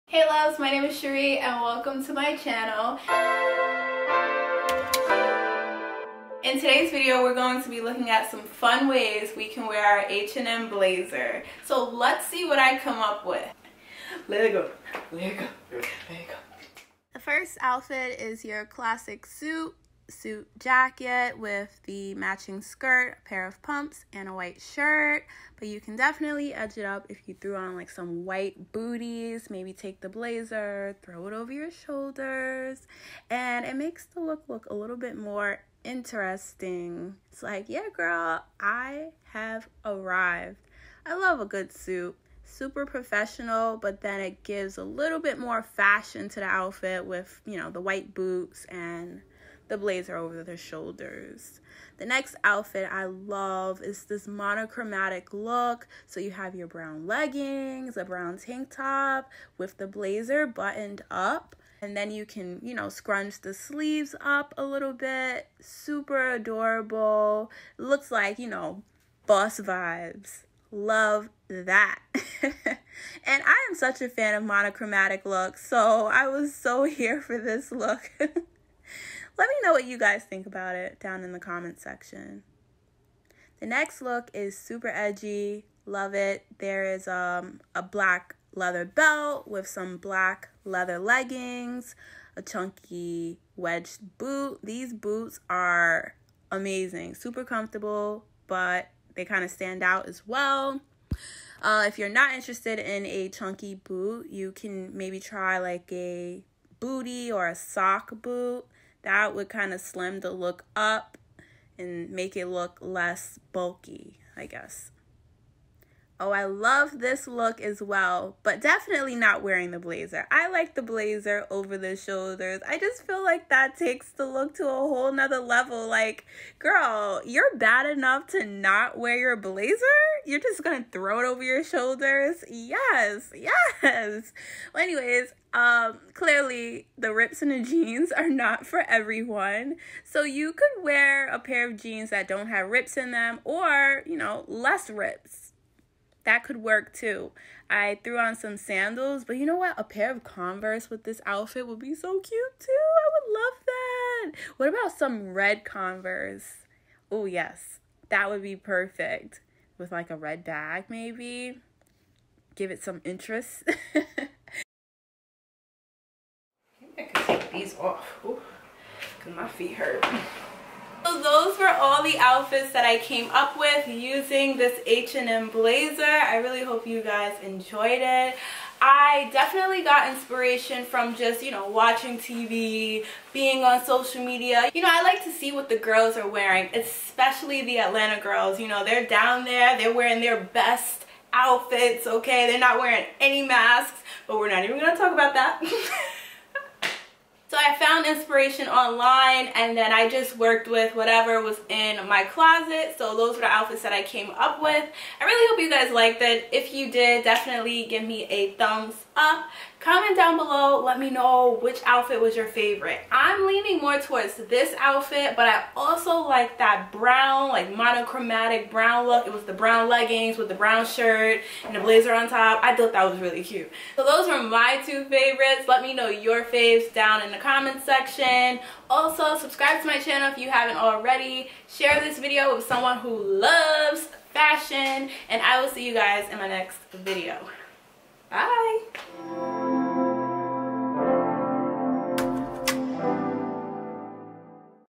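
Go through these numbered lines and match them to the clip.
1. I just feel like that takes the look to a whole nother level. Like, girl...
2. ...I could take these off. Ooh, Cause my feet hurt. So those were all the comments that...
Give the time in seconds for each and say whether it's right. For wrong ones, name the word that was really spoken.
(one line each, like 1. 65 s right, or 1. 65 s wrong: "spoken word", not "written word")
1. 122 s right
2. 166 s wrong: "outfits", not "comments".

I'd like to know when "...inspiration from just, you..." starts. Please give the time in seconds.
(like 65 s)
180 s.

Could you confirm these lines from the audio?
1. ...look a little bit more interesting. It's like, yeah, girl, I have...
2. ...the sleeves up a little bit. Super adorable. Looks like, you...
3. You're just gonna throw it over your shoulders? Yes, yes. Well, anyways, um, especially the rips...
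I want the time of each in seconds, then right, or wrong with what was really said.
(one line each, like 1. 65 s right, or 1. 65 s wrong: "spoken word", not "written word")
1. 34 s right
2. 63 s right
3. 130 s wrong: "clearly", not "especially".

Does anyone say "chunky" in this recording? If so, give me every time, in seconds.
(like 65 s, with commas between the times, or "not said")
92 s, 103 s.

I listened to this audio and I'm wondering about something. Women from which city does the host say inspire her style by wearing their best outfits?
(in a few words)
Atlanta.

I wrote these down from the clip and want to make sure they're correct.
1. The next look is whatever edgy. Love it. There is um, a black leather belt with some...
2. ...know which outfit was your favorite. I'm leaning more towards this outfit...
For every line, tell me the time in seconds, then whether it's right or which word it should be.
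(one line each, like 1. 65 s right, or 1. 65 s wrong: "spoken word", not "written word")
1. 83 s wrong: "super", not "whatever"
2. 211 s right.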